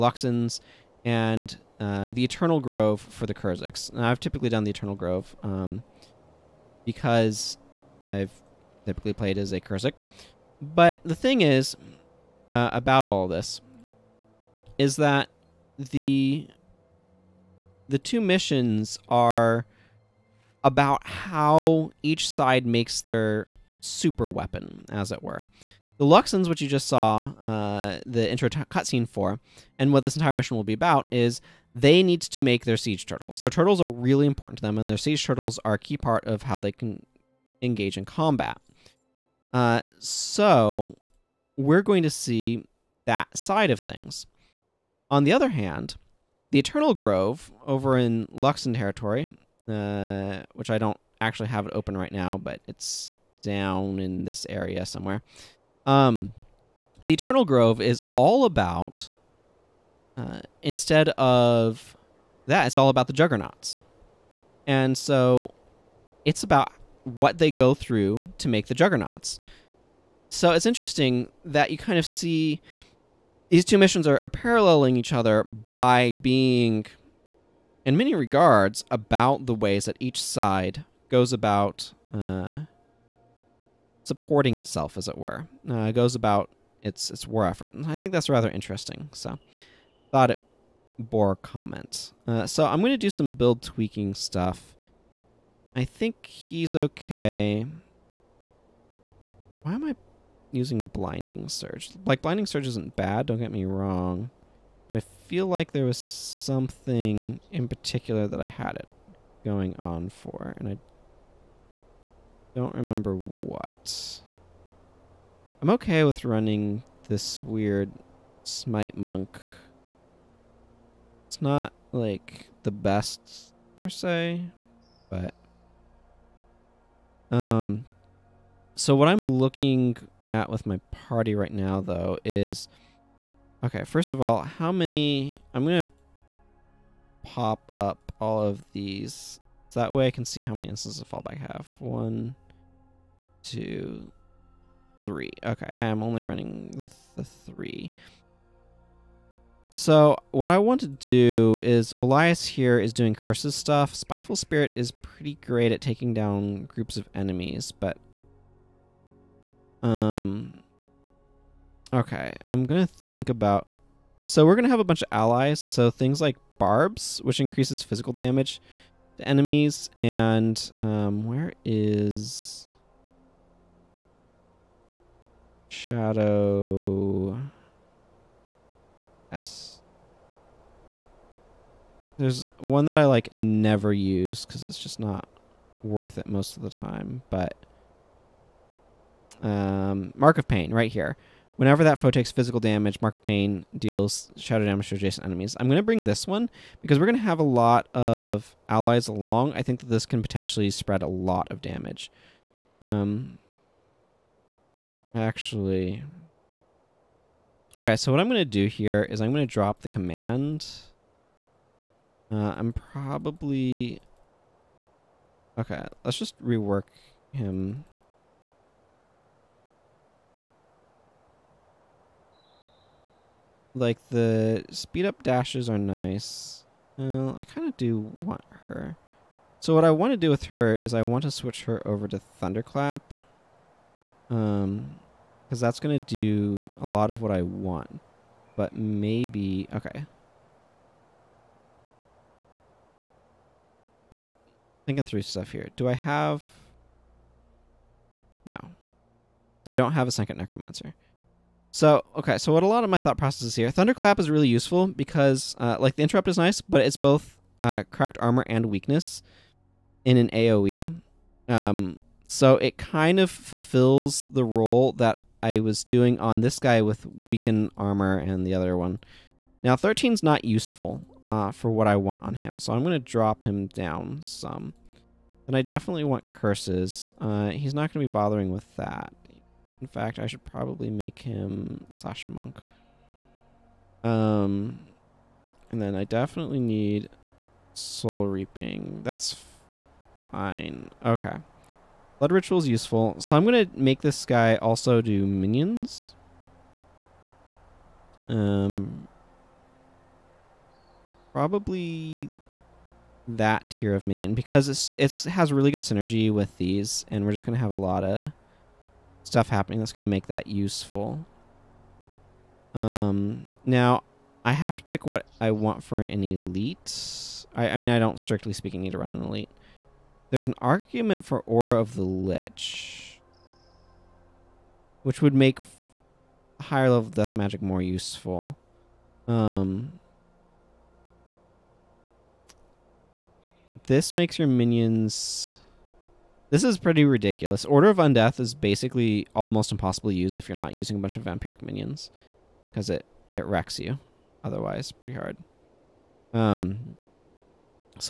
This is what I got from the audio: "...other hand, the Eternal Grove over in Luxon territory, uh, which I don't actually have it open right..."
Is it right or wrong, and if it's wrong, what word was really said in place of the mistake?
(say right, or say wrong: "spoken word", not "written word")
right.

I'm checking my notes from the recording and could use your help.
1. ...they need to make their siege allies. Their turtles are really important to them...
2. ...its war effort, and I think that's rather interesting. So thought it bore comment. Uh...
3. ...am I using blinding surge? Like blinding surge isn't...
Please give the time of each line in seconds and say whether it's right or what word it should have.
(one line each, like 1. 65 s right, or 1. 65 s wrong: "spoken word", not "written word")
1. 31 s wrong: "turtles", not "allies"
2. 87 s right
3. 99 s right.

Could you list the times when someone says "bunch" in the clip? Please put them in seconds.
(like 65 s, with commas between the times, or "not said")
164 s, 341 s.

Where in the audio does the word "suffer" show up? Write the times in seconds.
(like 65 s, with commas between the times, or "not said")
not said.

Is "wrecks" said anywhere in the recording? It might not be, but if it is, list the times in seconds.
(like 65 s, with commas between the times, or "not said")
343 s.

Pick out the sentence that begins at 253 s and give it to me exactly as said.
Thunderclap is really useful because, uh, like, the interrupt is nice, but it's both uh, cracked armor and weakness in an AoE.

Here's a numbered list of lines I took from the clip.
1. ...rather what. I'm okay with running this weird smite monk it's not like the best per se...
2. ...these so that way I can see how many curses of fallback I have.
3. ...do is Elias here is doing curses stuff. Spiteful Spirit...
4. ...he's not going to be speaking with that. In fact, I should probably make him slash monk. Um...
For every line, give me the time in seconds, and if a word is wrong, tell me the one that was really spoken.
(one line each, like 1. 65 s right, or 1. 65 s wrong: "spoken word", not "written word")
1. 112 s wrong: "remember", not "rather"
2. 138 s wrong: "instances", not "curses"
3. 150 s right
4. 277 s wrong: "bothering", not "speaking".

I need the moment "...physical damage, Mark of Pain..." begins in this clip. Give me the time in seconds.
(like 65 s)
192 s.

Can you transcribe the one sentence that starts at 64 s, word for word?
And so it's about what they go through to make the juggernauts.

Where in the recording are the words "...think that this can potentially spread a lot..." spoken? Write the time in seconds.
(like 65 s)
199 s.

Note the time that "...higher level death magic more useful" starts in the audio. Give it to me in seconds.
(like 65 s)
326 s.